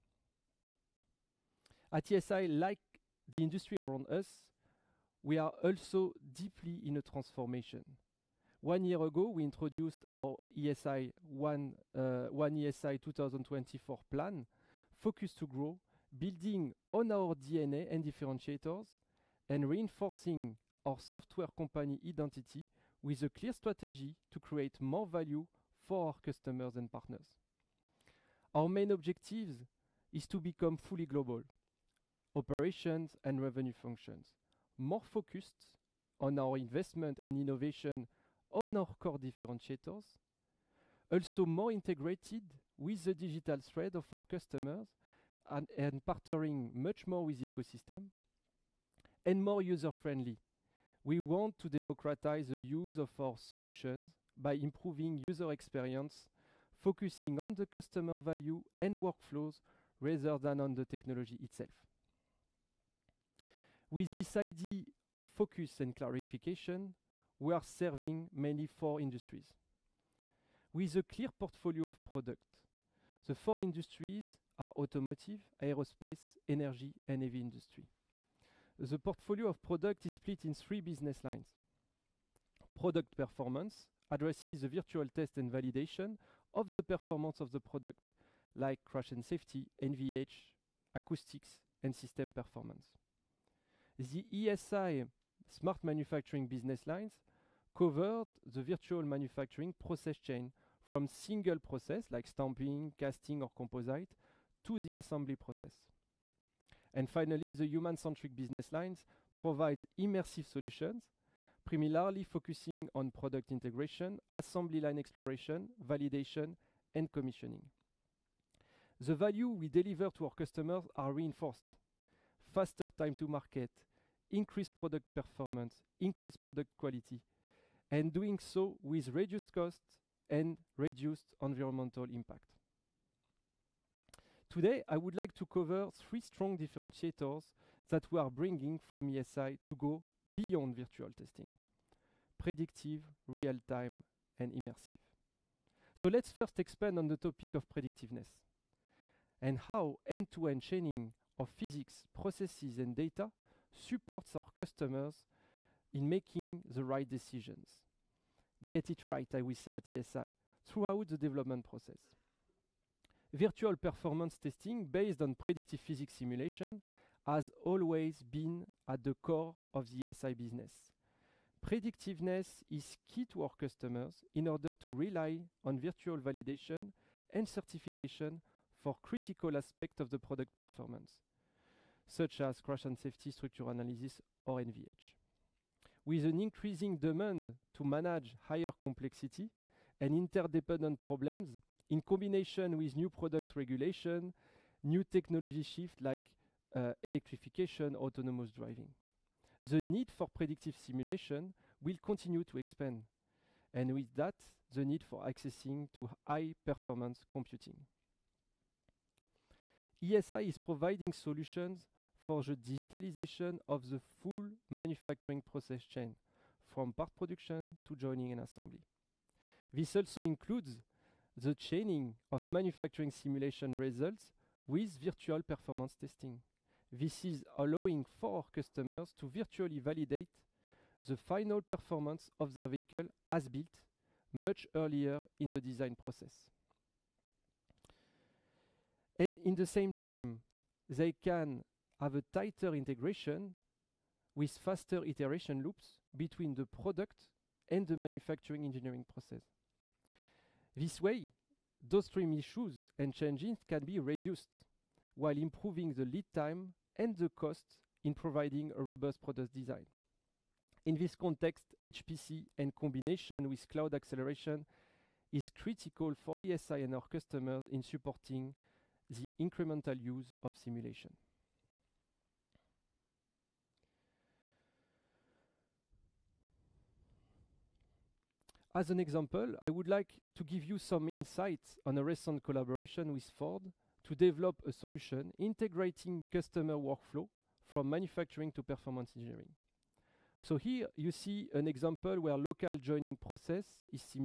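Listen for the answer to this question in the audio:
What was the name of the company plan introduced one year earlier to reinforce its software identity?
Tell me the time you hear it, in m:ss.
0:12.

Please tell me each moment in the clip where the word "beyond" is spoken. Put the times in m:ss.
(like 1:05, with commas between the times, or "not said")
2:20.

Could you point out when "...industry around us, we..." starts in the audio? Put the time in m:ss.
0:03.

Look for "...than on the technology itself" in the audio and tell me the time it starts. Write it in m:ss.
1:00.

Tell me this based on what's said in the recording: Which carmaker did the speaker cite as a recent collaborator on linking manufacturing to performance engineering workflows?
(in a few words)
Ford.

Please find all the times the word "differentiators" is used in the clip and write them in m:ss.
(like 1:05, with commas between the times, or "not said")
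0:18, 0:39, 2:16.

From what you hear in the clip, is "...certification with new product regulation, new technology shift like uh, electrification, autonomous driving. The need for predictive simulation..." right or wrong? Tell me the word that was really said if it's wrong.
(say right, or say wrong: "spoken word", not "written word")
wrong: "combination", not "certification".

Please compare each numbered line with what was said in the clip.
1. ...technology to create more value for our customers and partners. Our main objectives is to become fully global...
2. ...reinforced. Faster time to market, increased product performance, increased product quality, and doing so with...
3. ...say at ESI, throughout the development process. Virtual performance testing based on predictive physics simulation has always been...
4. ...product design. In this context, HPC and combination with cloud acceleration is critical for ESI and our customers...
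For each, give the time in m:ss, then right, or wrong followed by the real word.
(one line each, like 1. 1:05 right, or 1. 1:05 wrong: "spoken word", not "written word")
1. 0:23 wrong: "strategy", not "technology"
2. 2:01 right
3. 2:39 right
4. 4:19 right.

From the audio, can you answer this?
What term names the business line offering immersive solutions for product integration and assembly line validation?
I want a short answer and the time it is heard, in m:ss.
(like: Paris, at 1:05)
human-centric, at 1:47.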